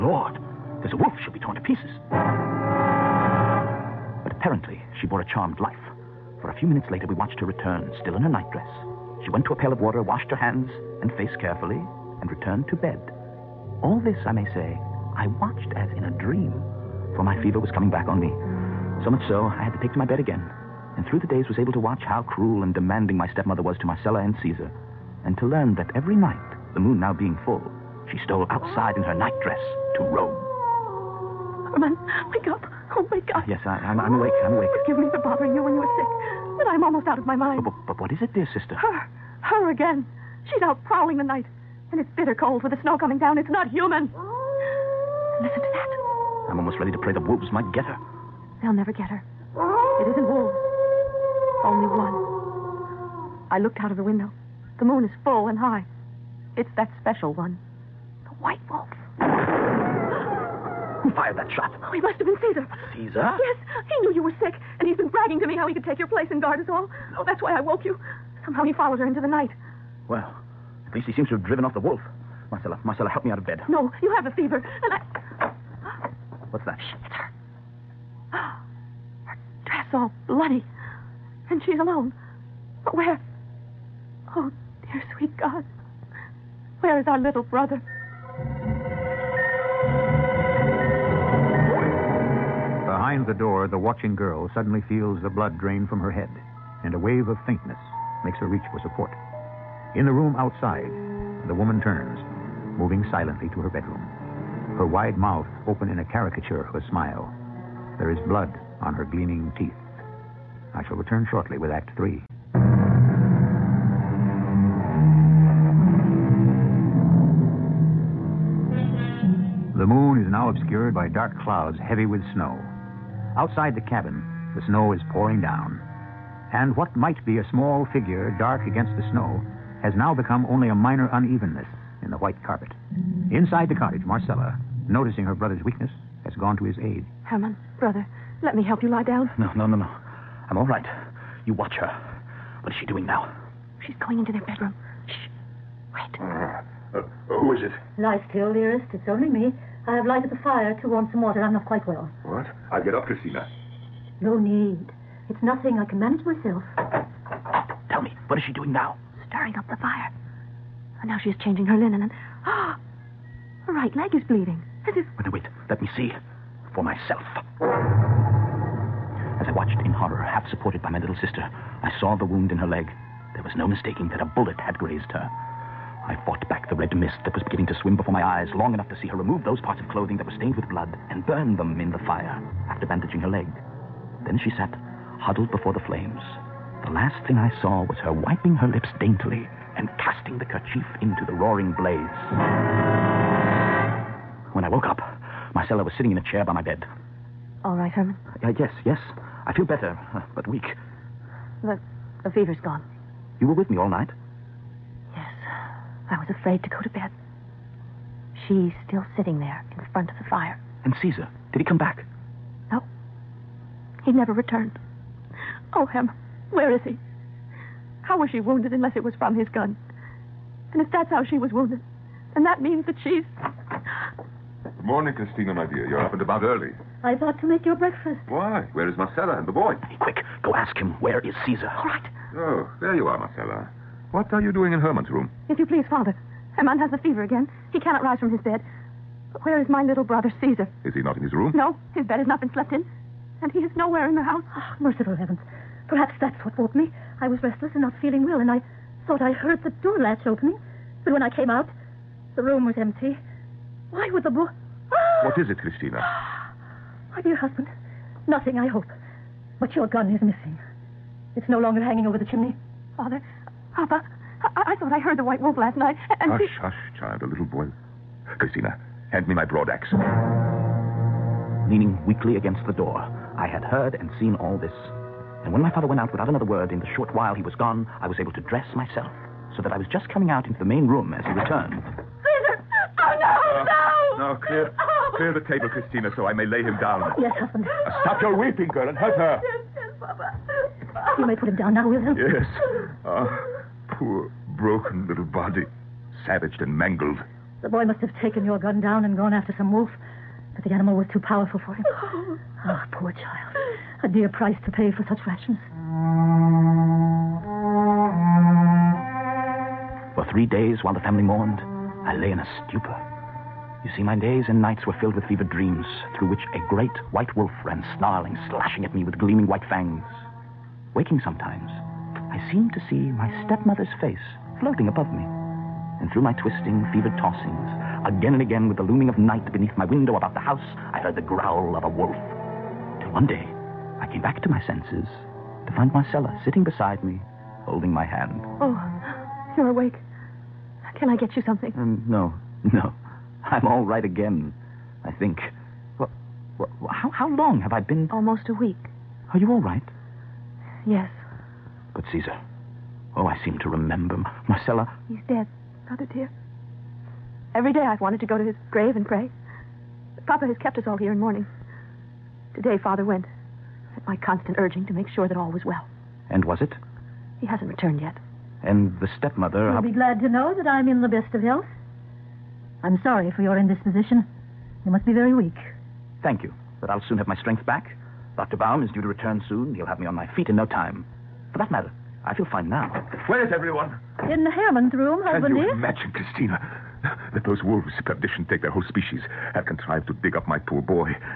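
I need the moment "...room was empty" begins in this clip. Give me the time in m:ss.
4:12.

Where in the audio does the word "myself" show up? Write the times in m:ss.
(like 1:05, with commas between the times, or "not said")
2:36, 2:46, 4:38.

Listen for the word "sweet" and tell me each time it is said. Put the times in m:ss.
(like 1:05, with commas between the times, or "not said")
1:25.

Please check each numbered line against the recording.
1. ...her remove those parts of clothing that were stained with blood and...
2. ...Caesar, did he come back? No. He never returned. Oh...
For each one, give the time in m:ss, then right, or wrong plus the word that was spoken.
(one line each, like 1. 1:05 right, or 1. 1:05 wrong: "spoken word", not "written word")
1. 2:59 right
2. 3:31 right.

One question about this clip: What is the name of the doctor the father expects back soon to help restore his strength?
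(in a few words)
Dr. Baum.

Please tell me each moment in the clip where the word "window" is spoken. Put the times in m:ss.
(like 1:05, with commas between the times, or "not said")
0:54, 5:29.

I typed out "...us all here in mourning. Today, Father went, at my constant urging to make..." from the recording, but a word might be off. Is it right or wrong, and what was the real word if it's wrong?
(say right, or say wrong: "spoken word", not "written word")
right.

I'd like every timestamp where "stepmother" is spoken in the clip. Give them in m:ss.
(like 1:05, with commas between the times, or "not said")
0:23, 5:23, 6:09.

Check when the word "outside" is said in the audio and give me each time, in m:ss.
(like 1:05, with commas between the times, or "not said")
0:28, 1:40, 2:03.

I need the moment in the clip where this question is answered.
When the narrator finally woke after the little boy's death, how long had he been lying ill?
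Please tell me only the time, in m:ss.
5:48.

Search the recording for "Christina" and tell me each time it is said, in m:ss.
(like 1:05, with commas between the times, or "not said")
2:33, 3:45, 4:15, 4:28, 4:45, 6:26.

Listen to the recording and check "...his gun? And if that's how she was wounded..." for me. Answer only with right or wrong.
right.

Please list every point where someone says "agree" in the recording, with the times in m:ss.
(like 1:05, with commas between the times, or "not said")
not said.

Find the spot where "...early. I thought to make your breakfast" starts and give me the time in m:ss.
3:46.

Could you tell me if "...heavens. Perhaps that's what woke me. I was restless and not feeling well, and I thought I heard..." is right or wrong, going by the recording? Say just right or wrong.
right.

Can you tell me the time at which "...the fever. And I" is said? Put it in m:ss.
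1:14.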